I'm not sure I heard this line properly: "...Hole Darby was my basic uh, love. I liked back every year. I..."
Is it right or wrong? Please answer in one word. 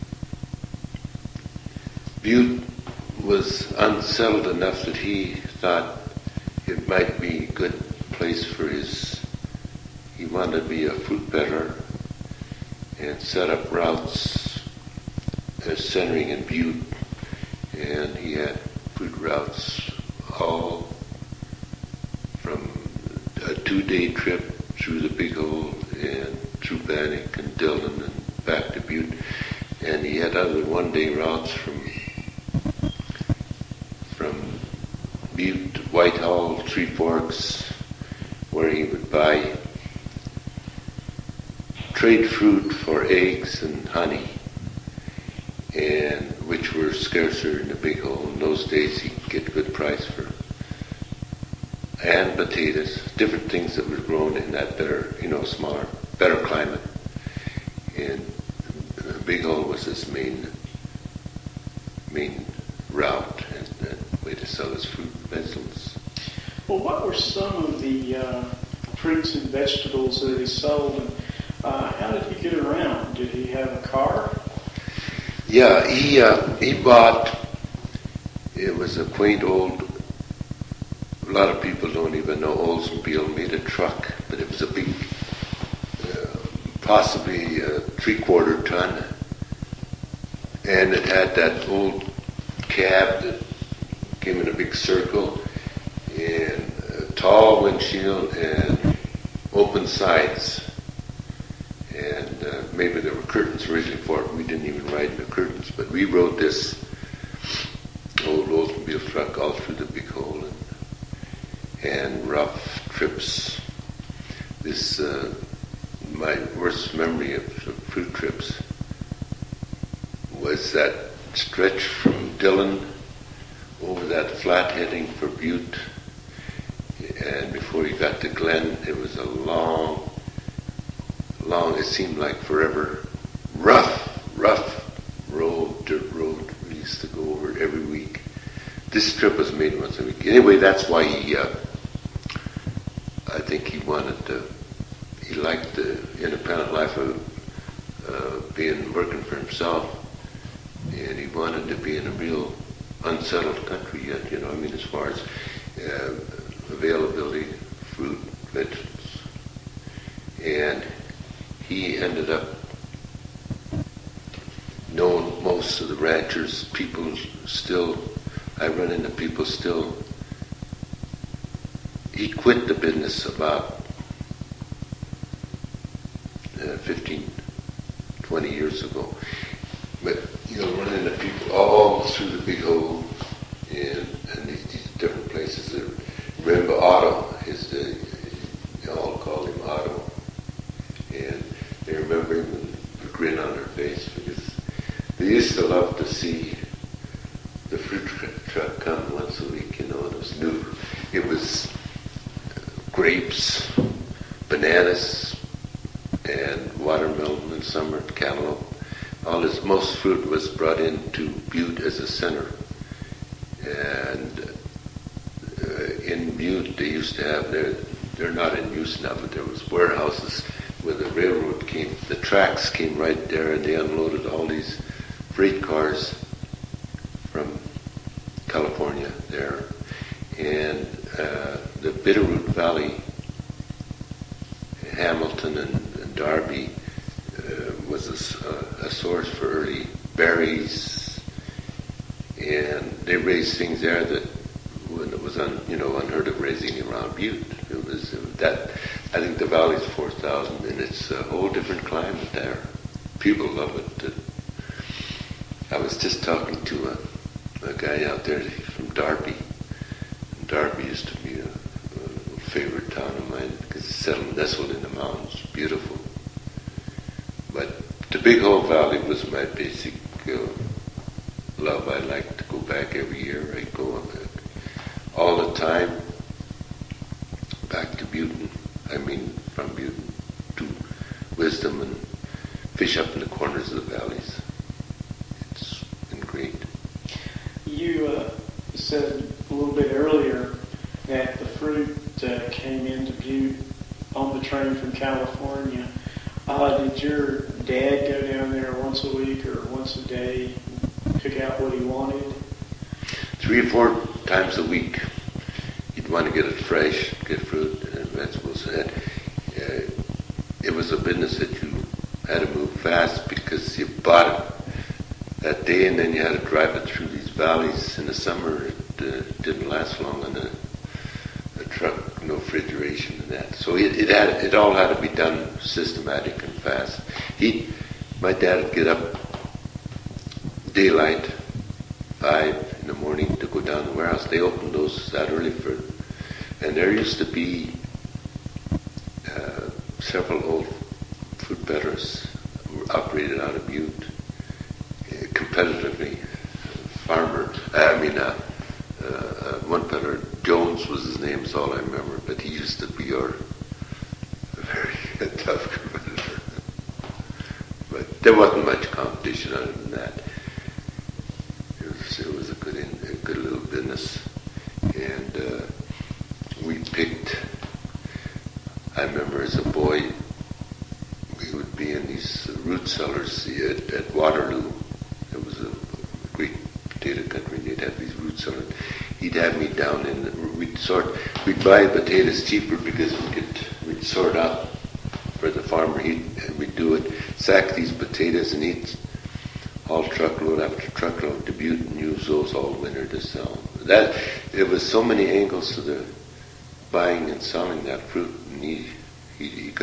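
wrong.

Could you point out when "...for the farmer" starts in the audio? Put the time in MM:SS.
06:25.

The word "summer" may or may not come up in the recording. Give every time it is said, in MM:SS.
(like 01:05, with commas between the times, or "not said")
05:18.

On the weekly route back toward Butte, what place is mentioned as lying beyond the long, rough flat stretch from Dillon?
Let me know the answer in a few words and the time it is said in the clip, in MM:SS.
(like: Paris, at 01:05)
Glen, at 02:08.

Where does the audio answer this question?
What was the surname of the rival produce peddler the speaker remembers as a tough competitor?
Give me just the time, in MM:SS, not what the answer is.
05:50.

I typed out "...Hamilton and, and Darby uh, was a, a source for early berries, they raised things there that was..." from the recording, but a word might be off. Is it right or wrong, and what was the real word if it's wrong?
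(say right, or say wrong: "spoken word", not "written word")
right.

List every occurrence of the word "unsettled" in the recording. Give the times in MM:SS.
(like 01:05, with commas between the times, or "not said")
00:03, 02:33.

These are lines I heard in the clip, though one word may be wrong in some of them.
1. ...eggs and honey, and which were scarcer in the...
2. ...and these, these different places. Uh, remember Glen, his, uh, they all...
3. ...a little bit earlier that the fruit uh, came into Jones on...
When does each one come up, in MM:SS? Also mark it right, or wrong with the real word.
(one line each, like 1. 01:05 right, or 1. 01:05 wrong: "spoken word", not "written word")
1. 00:43 right
2. 03:04 wrong: "Otto", not "Glen"
3. 04:49 wrong: "Butte", not "Jones".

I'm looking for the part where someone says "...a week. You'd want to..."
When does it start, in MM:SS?
05:04.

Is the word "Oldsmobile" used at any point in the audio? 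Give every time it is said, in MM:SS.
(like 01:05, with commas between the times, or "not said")
01:22, 01:48.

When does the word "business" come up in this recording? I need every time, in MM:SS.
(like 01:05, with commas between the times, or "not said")
02:52, 05:10, 06:03.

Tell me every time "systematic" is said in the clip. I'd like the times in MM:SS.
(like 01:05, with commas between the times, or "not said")
05:25.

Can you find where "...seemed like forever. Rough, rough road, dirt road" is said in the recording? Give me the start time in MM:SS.
02:11.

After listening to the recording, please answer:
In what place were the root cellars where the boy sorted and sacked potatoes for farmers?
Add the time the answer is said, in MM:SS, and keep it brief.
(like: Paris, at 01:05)
Waterloo, at 06:14.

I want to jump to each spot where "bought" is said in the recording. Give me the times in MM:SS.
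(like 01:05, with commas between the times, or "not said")
01:16, 05:13.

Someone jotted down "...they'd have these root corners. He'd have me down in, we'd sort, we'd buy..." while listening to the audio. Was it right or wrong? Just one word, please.
wrong.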